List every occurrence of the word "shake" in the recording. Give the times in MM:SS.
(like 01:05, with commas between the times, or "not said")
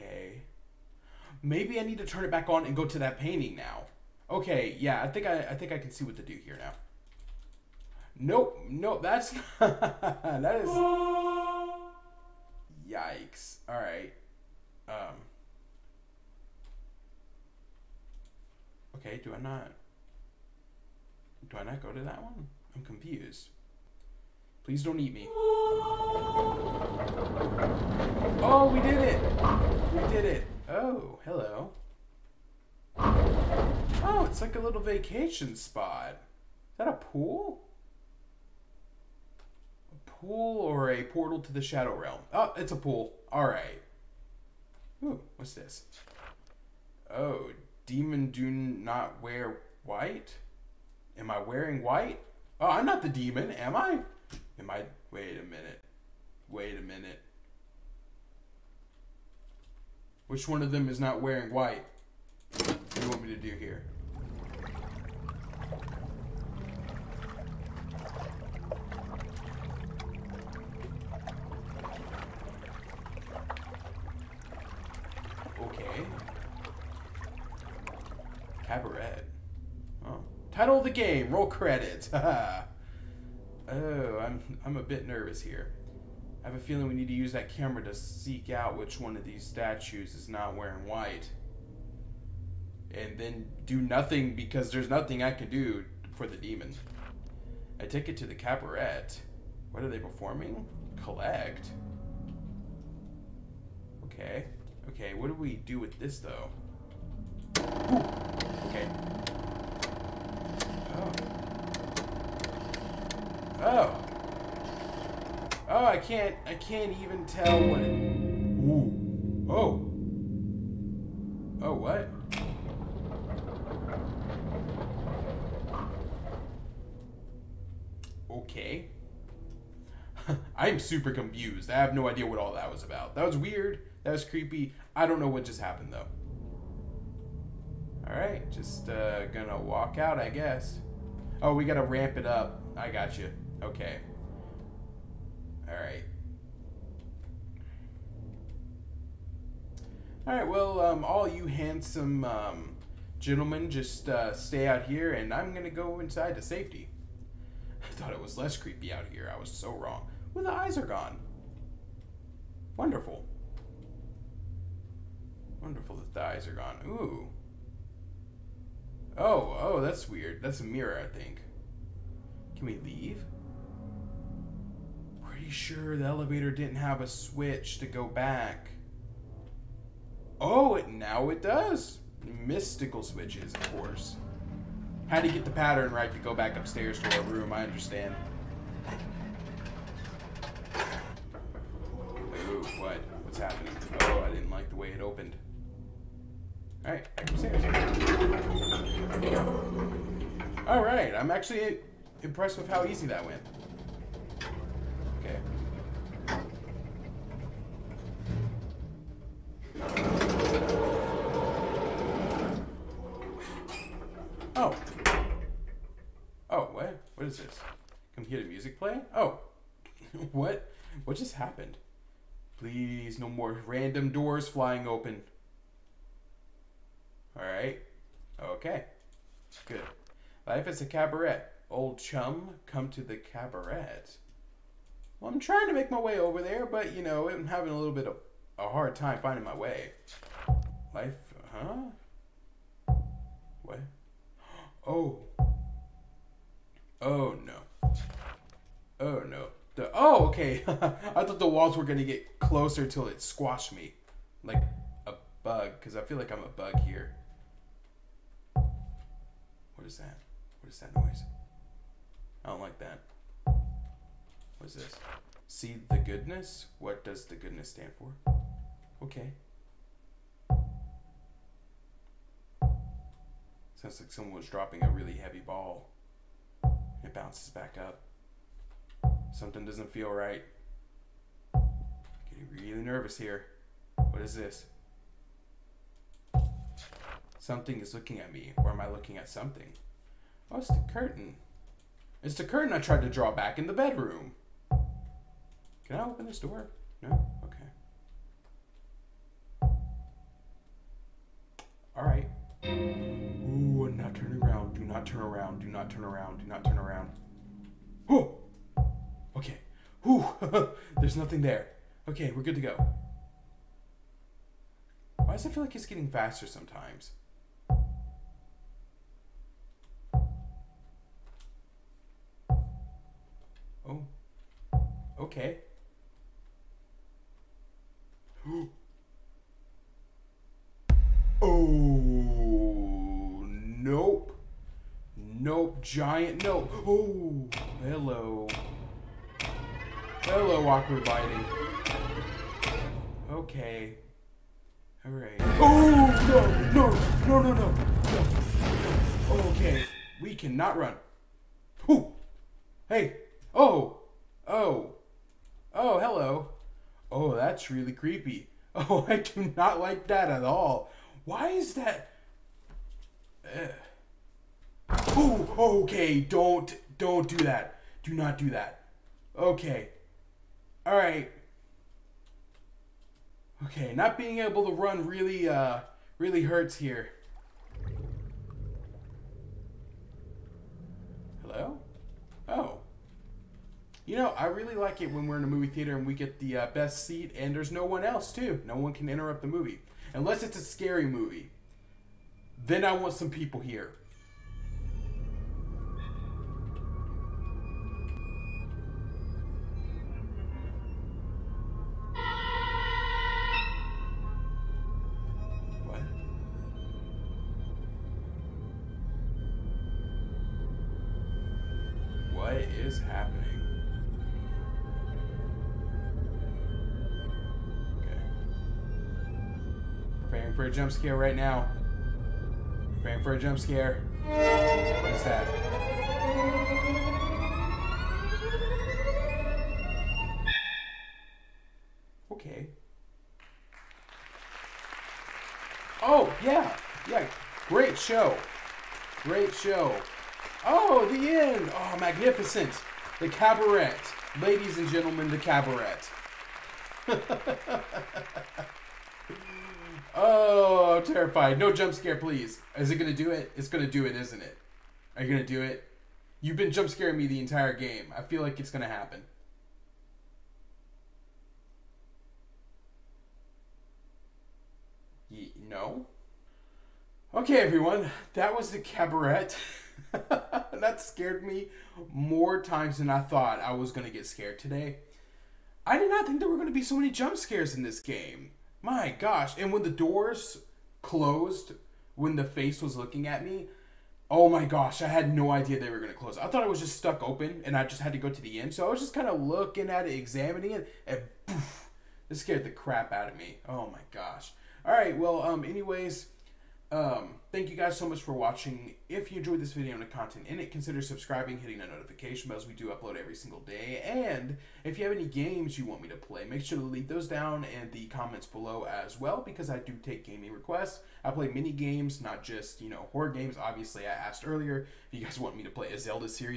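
not said.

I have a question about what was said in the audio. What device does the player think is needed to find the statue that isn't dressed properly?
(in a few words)
camera.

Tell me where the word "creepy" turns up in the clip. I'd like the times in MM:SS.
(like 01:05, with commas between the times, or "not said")
02:14, 02:38, 05:57.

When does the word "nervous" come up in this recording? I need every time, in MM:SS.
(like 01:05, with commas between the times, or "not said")
01:25, 04:42.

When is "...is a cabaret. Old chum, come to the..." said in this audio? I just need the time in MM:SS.
03:50.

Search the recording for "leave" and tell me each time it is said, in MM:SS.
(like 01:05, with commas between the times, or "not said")
02:52, 08:26.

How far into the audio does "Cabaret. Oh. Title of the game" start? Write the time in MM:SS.
01:18.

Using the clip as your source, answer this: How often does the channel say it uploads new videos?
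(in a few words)
every single day.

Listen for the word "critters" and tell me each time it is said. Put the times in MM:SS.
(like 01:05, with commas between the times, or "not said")
not said.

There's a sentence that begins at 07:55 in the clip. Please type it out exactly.
I did not think there were going to be so many jump scares in this game.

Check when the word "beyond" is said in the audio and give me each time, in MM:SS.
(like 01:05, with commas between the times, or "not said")
not said.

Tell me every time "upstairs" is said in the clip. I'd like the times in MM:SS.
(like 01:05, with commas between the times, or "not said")
03:06, 03:17.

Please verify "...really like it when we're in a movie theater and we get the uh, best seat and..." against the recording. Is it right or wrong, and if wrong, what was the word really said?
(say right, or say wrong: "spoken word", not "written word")
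right.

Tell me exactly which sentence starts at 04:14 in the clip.
Like a bug, because I feel like I'm a bug here.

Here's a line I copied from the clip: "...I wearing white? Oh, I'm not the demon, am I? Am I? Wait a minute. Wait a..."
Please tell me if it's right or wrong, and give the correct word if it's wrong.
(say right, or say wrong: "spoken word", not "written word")
right.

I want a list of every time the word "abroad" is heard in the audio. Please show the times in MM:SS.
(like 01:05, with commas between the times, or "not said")
not said.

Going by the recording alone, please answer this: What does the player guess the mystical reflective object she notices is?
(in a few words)
a mirror.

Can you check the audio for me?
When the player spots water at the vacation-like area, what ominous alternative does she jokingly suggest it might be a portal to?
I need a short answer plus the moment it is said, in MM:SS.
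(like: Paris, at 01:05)
the Shadow Realm, at 00:41.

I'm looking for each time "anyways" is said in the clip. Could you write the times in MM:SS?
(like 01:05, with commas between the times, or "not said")
08:15.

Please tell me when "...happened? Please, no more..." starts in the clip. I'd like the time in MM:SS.
03:41.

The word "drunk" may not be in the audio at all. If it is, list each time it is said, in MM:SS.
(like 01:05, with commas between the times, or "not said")
not said.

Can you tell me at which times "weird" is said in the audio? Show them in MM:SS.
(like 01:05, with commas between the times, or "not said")
02:13, 02:50.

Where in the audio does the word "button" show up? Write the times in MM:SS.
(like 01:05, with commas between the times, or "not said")
not said.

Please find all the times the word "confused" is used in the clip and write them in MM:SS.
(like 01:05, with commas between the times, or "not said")
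00:22, 02:11.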